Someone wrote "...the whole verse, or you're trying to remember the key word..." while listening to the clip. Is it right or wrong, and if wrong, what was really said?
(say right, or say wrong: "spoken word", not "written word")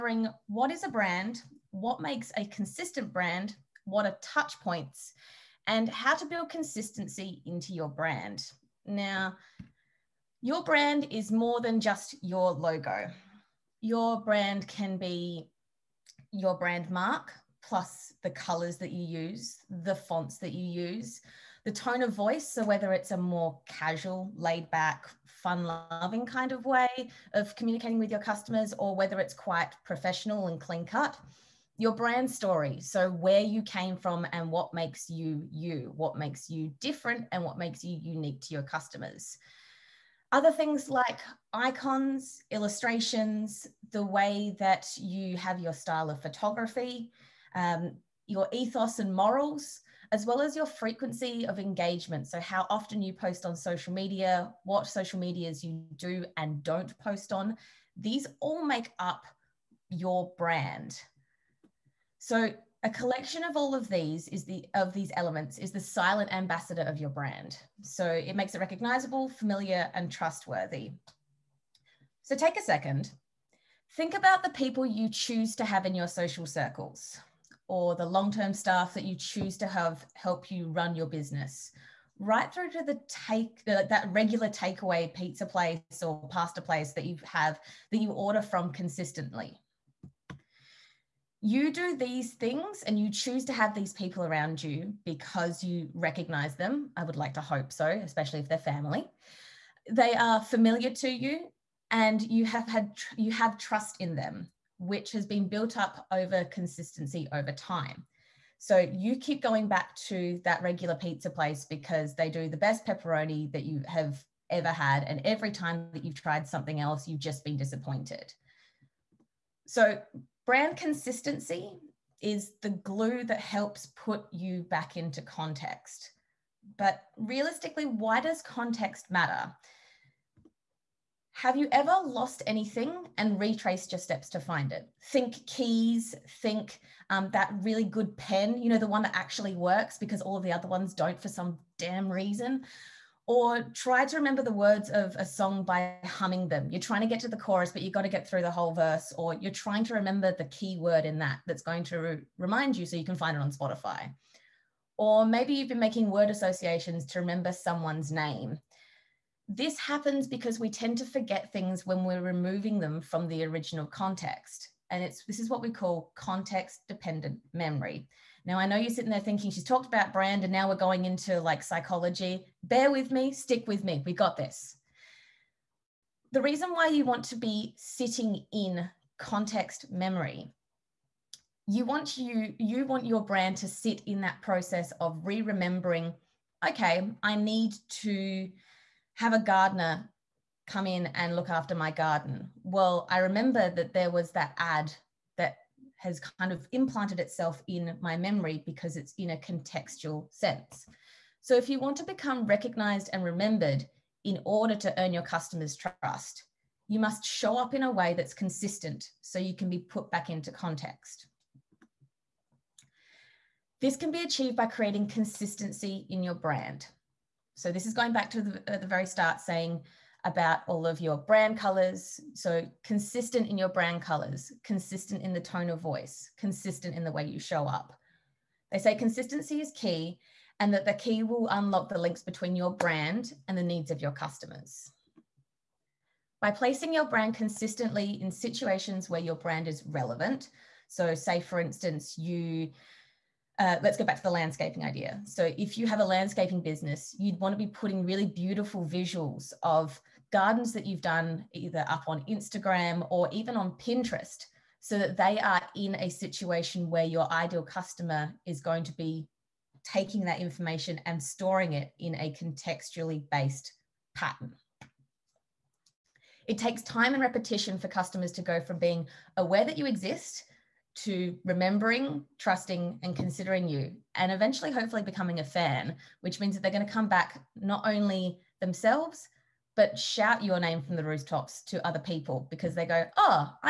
right.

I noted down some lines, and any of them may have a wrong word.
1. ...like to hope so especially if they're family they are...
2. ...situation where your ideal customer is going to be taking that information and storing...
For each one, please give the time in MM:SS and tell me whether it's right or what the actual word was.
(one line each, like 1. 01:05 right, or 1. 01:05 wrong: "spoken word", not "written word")
1. 01:37 right
2. 04:16 right.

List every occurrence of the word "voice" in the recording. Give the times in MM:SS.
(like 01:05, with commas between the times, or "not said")
00:22, 03:45.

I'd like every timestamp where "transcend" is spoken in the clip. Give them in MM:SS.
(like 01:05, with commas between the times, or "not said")
not said.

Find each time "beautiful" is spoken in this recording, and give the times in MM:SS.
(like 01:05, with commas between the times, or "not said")
04:08.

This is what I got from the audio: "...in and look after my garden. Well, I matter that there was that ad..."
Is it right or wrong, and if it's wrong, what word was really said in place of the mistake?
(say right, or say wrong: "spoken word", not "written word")
wrong: "remember", not "matter".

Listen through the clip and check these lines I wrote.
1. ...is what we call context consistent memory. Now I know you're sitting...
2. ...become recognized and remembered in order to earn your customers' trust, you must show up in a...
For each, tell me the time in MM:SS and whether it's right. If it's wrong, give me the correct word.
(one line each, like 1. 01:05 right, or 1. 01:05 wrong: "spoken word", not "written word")
1. 02:45 wrong: "dependent", not "consistent"
2. 03:22 right.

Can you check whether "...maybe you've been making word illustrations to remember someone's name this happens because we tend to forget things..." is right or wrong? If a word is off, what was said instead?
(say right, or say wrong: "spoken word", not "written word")
wrong: "associations", not "illustrations".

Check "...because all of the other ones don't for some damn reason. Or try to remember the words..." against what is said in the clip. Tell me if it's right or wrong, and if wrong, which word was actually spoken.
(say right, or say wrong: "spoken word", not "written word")
right.